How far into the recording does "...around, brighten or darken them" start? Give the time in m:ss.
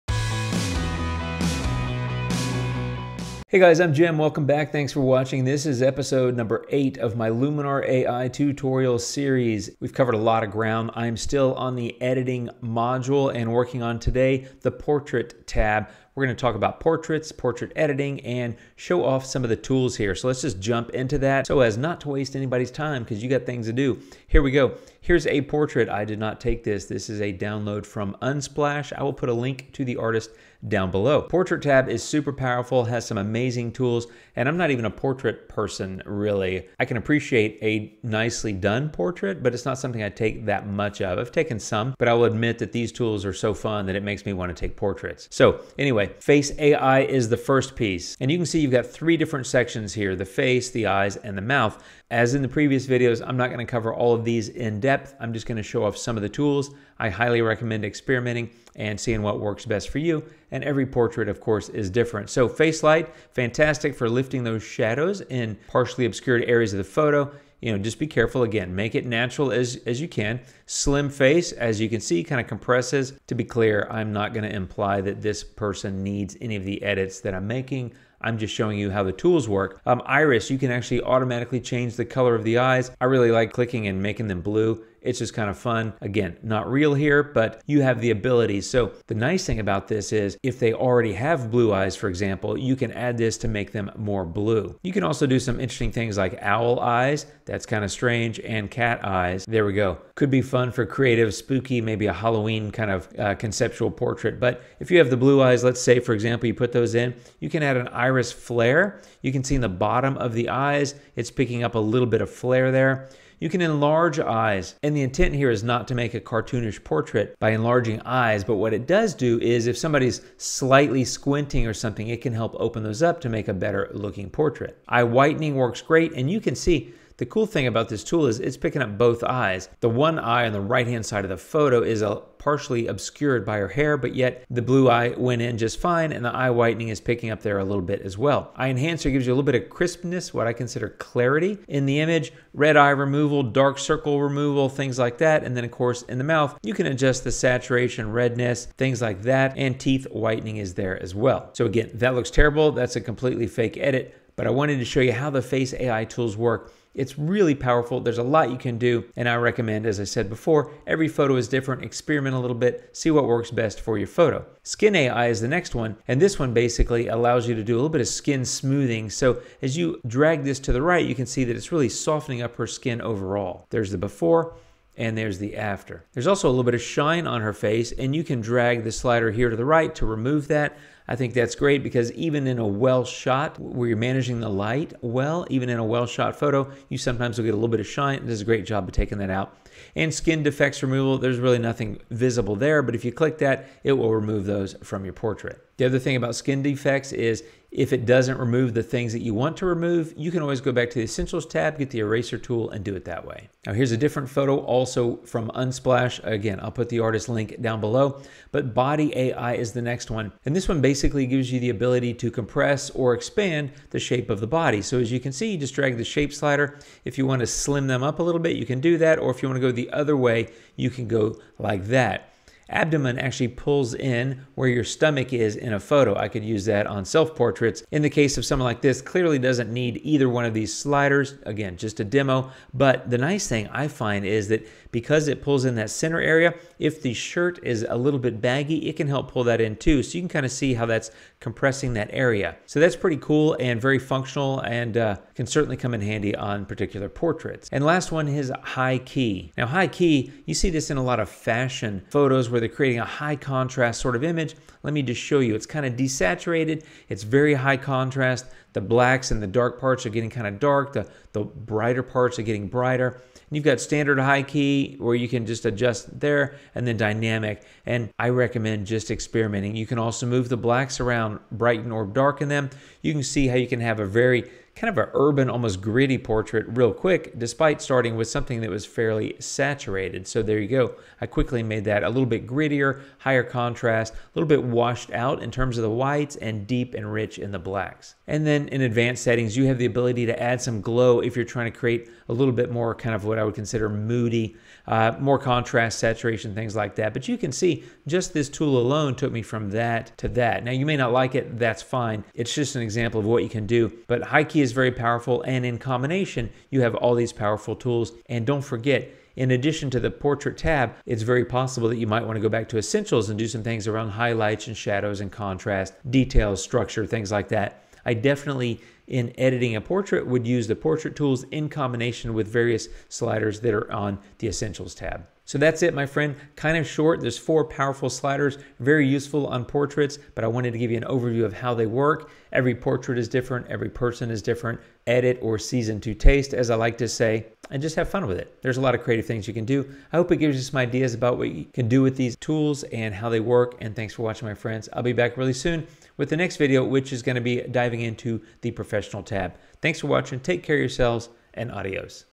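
4:30.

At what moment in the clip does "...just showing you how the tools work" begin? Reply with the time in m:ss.
1:18.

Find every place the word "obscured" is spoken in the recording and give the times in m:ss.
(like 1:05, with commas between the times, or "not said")
1:06, 2:12.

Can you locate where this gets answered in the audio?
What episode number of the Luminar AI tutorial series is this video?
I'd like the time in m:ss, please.
0:05.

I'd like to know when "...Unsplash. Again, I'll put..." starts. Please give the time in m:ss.
3:25.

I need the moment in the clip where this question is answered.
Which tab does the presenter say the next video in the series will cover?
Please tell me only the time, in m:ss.
5:48.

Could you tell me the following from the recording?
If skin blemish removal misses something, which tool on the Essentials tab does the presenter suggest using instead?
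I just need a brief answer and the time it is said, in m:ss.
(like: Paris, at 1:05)
Eraser tool, at 3:21.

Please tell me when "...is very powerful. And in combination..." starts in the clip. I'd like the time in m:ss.
5:04.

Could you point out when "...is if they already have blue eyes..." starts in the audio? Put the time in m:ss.
1:30.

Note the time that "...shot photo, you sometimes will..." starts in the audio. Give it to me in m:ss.
3:06.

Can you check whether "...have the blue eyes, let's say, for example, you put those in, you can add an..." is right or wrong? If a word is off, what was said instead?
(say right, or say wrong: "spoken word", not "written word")
right.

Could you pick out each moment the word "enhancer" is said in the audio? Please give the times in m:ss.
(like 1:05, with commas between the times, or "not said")
2:18.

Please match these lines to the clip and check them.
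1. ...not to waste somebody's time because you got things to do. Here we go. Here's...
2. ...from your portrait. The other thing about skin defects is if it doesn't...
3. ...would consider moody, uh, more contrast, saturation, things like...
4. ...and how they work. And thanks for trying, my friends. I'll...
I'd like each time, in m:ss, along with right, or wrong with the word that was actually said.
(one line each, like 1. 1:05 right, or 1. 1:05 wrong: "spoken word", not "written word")
1. 0:21 wrong: "anybody", not "somebody"
2. 3:14 right
3. 4:53 right
4. 5:42 wrong: "watching", not "trying".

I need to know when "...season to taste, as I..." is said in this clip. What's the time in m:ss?
5:35.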